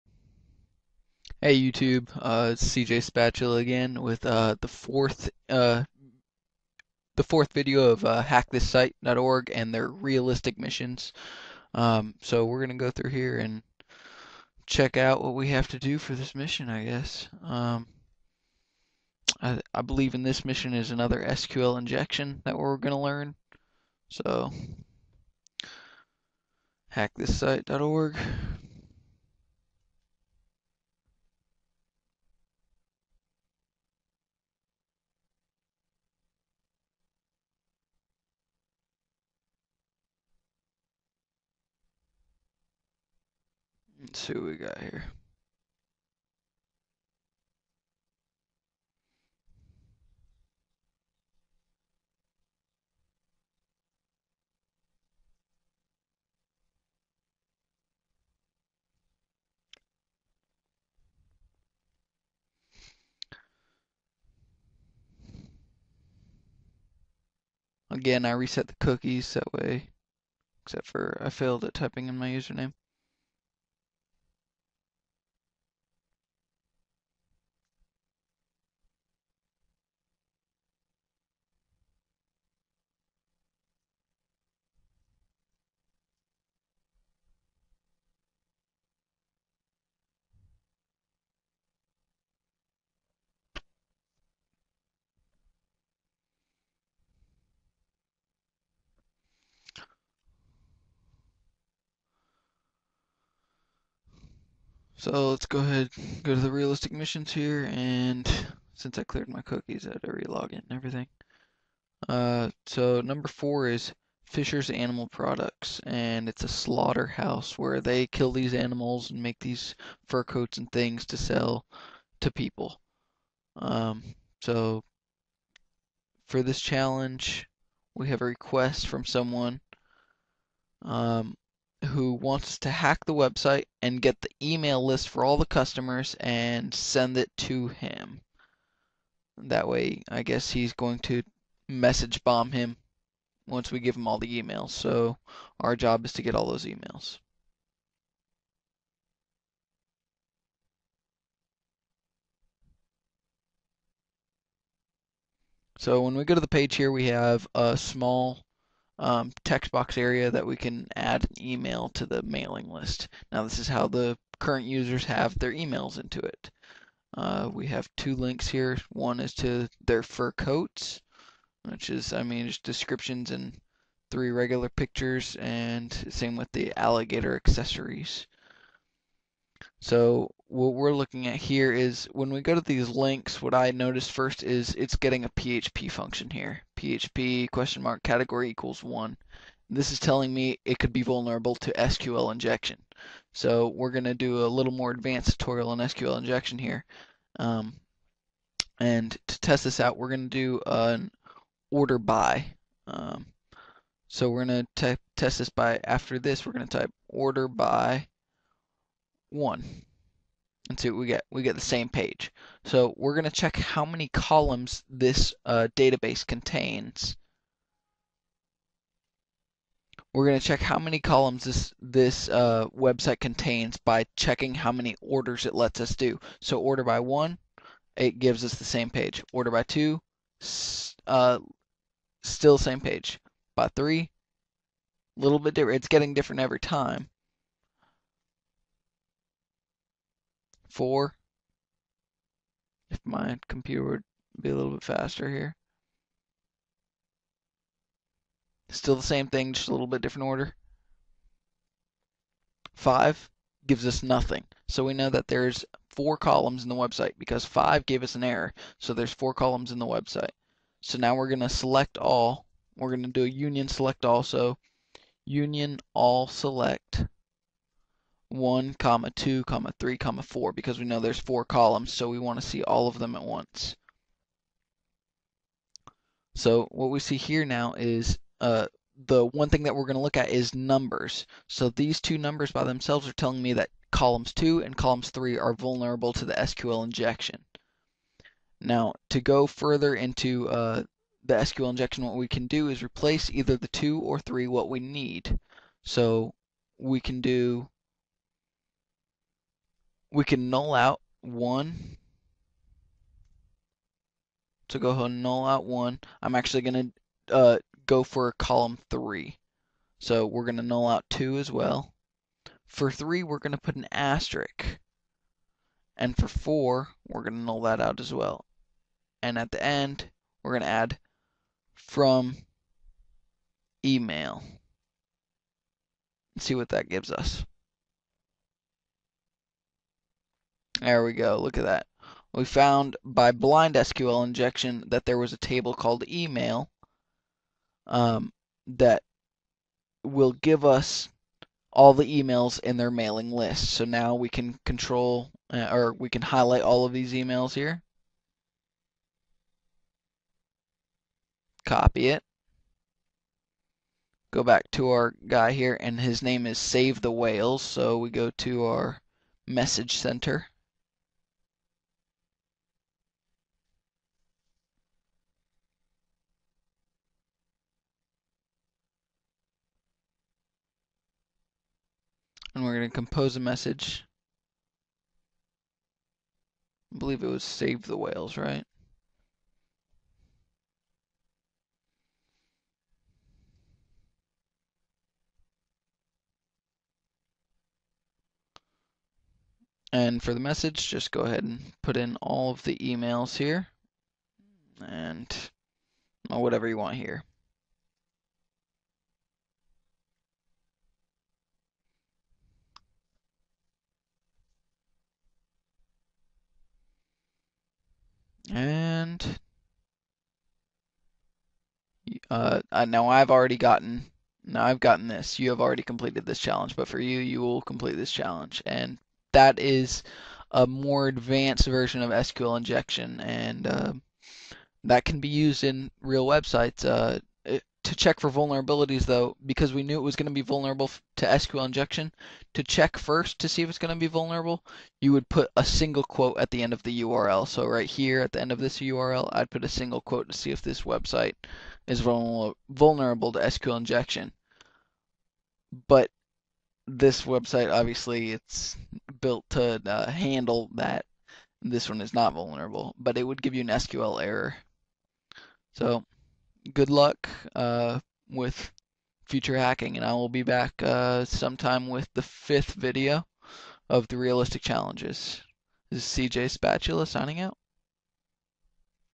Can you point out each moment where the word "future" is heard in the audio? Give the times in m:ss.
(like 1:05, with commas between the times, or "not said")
7:39.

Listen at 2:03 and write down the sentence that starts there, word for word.
Um, so for this challenge, we have a request from someone.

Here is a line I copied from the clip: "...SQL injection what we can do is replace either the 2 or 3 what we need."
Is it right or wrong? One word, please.
right.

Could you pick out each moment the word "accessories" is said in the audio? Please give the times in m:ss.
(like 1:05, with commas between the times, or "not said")
2:57.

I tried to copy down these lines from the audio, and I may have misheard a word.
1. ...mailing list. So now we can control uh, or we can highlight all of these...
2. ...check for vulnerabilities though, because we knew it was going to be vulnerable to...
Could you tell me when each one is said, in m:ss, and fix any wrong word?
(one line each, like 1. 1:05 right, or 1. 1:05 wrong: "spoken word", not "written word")
1. 5:42 right
2. 7:07 right.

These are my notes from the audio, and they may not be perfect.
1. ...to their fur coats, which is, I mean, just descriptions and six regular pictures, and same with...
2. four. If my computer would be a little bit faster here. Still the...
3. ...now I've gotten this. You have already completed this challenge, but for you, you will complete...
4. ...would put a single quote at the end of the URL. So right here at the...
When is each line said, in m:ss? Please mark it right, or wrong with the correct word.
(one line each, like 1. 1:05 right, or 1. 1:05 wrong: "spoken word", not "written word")
1. 2:49 wrong: "three", not "six"
2. 4:00 right
3. 6:54 right
4. 7:15 right.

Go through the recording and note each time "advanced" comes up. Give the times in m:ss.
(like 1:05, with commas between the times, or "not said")
3:14, 7:01.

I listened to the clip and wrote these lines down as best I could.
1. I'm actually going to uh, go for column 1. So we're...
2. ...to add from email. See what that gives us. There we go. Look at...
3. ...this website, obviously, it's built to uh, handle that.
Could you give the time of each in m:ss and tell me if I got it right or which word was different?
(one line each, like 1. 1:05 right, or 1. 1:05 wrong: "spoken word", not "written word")
1. 5:06 wrong: "3", not "1"
2. 5:20 right
3. 7:26 right.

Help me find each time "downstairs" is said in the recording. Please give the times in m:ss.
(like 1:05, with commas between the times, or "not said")
not said.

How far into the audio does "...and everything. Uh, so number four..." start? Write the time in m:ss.
1:50.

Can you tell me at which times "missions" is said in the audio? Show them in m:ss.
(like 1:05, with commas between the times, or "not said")
0:10, 0:16, 0:20, 1:46.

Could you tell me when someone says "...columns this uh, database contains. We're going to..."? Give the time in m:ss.
3:34.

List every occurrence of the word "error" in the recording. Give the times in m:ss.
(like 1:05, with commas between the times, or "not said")
4:18, 7:34.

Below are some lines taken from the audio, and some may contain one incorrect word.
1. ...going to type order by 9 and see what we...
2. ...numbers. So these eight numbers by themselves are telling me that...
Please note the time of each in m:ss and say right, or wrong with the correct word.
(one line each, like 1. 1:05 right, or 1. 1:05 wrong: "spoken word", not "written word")
1. 3:26 wrong: "1", not "9"
2. 4:40 wrong: "two", not "eight".